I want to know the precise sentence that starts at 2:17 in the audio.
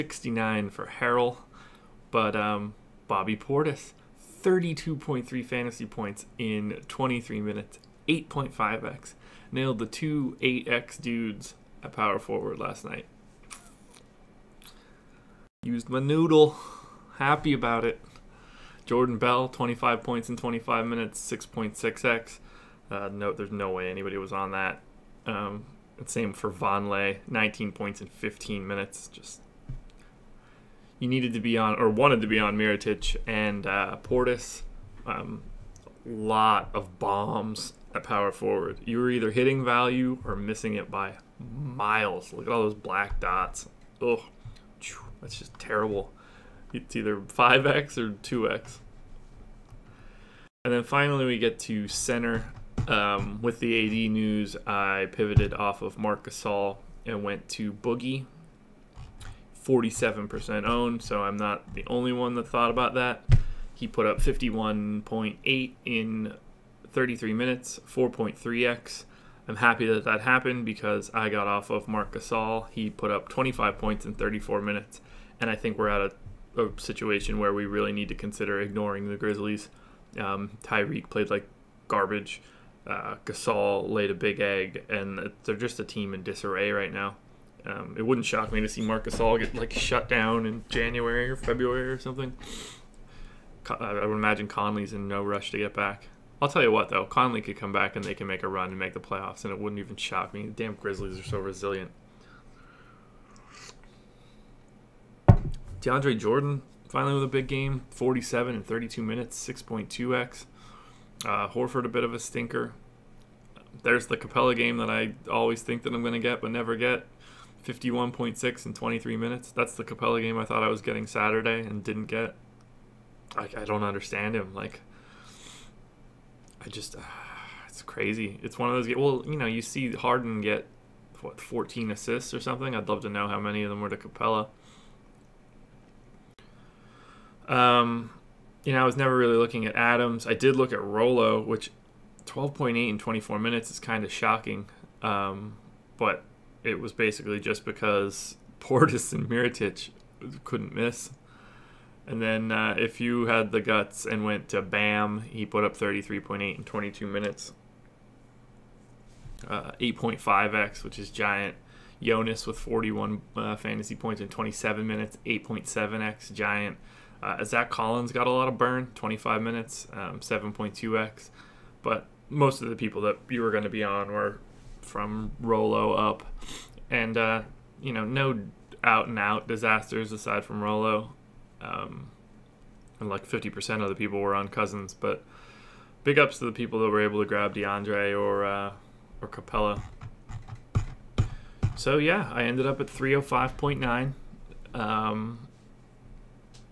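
Um, you know, I was never really looking at Adams.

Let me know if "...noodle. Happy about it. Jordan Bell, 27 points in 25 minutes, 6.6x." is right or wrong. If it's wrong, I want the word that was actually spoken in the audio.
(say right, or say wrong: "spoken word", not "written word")
wrong: "25", not "27".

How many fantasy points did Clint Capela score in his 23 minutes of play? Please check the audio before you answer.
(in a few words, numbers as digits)
51.6.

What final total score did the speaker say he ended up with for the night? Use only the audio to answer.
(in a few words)
305.9.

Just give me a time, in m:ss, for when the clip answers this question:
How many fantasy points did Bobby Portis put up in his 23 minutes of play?
0:04.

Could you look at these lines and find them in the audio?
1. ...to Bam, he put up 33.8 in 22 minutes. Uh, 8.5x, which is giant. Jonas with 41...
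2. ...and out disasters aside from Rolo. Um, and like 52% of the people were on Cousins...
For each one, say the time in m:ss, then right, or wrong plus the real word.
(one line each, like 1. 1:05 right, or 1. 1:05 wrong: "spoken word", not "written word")
1. 2:34 right
2. 2:59 wrong: "50", not "52".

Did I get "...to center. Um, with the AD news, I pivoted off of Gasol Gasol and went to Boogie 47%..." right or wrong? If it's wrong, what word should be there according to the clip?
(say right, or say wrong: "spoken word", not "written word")
wrong: "Marc", not "Gasol".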